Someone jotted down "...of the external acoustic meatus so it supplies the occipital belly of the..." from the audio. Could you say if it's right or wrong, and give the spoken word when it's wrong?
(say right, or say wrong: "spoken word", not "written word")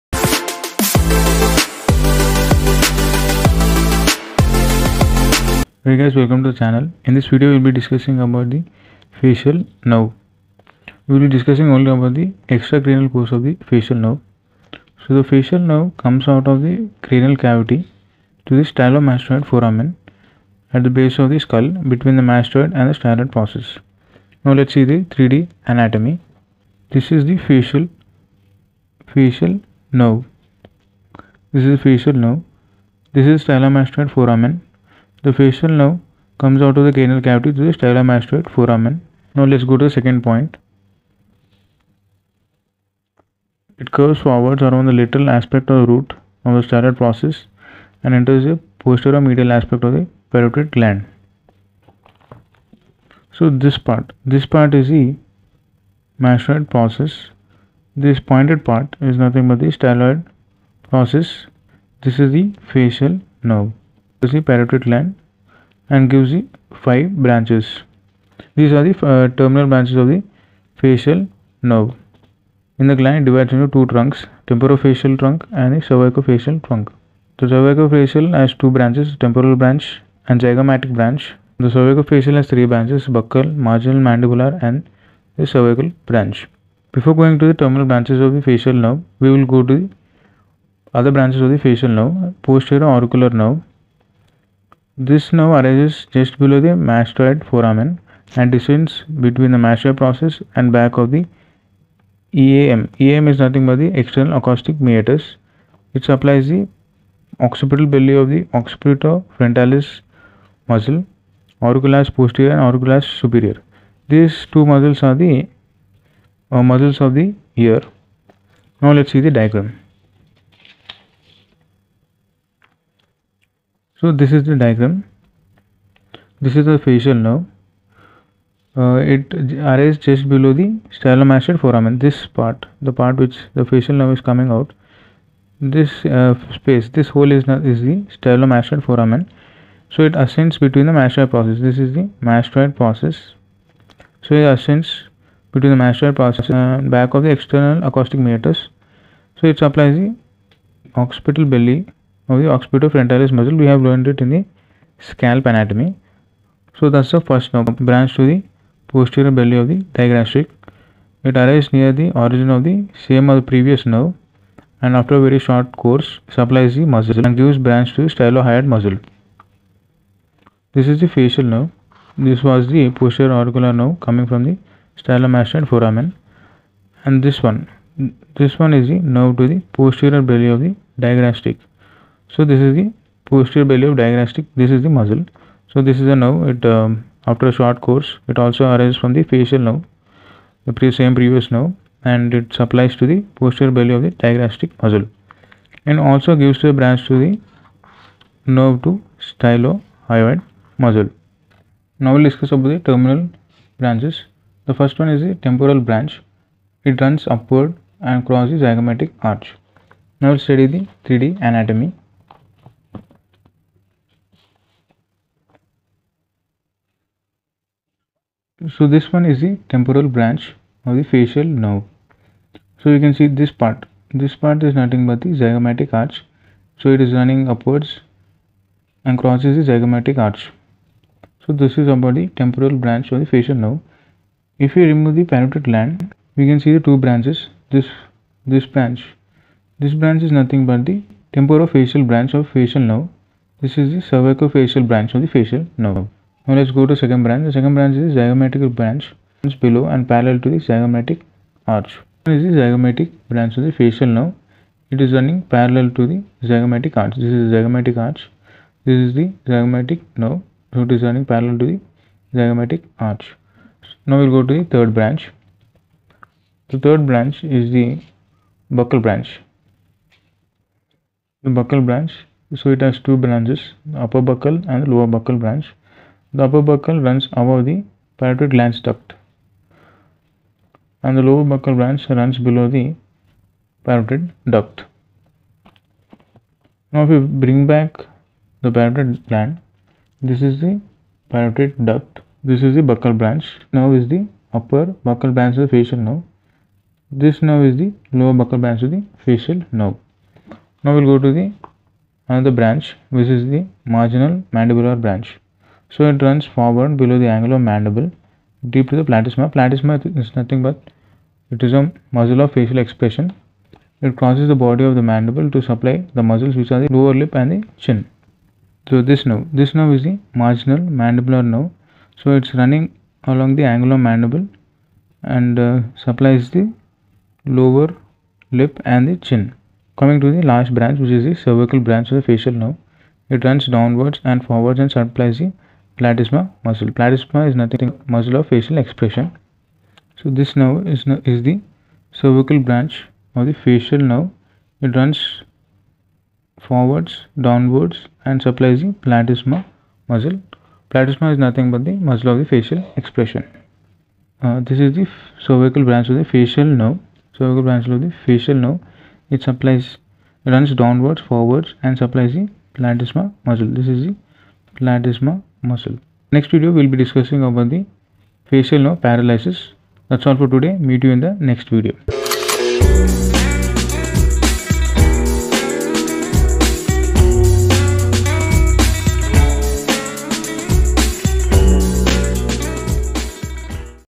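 right.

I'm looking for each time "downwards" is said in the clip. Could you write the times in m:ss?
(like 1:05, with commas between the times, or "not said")
5:33, 5:47, 6:00.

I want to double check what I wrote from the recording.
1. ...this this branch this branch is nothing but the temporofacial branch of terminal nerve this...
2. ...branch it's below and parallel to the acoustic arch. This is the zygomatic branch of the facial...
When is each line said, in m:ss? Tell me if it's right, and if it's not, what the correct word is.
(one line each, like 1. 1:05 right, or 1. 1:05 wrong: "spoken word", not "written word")
1. 3:57 wrong: "facial", not "terminal"
2. 4:08 wrong: "zygomatic", not "acoustic".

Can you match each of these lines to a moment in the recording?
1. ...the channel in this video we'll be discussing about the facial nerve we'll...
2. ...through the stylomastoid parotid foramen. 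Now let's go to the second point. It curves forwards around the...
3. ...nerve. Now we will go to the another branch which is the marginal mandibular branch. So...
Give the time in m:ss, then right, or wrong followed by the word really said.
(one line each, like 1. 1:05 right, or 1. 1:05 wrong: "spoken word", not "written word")
1. 0:06 right
2. 0:37 wrong: "mastoid", not "parotid"
3. 4:59 right.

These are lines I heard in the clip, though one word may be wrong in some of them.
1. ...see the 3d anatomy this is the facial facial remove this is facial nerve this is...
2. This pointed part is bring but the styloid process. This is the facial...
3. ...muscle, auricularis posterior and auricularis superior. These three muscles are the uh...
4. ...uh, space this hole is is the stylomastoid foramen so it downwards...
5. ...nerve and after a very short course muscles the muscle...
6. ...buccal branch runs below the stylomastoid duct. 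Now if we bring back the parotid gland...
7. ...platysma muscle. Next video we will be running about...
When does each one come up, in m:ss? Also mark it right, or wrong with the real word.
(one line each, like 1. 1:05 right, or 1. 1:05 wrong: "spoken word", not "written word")
1. 0:24 wrong: "nerve", not "remove"
2. 0:57 wrong: "nothing", not "bring"
3. 1:50 wrong: "two", not "three"
4. 2:16 wrong: "ascends", not "downwards"
5. 2:43 wrong: "supplies", not "muscles"
6. 4:41 wrong: "parotid", not "stylomastoid"
7. 6:04 wrong: "discussing", not "running".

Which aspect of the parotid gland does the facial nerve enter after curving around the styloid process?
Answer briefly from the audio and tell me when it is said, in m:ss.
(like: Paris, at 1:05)
Posterior medial aspect, at 0:48.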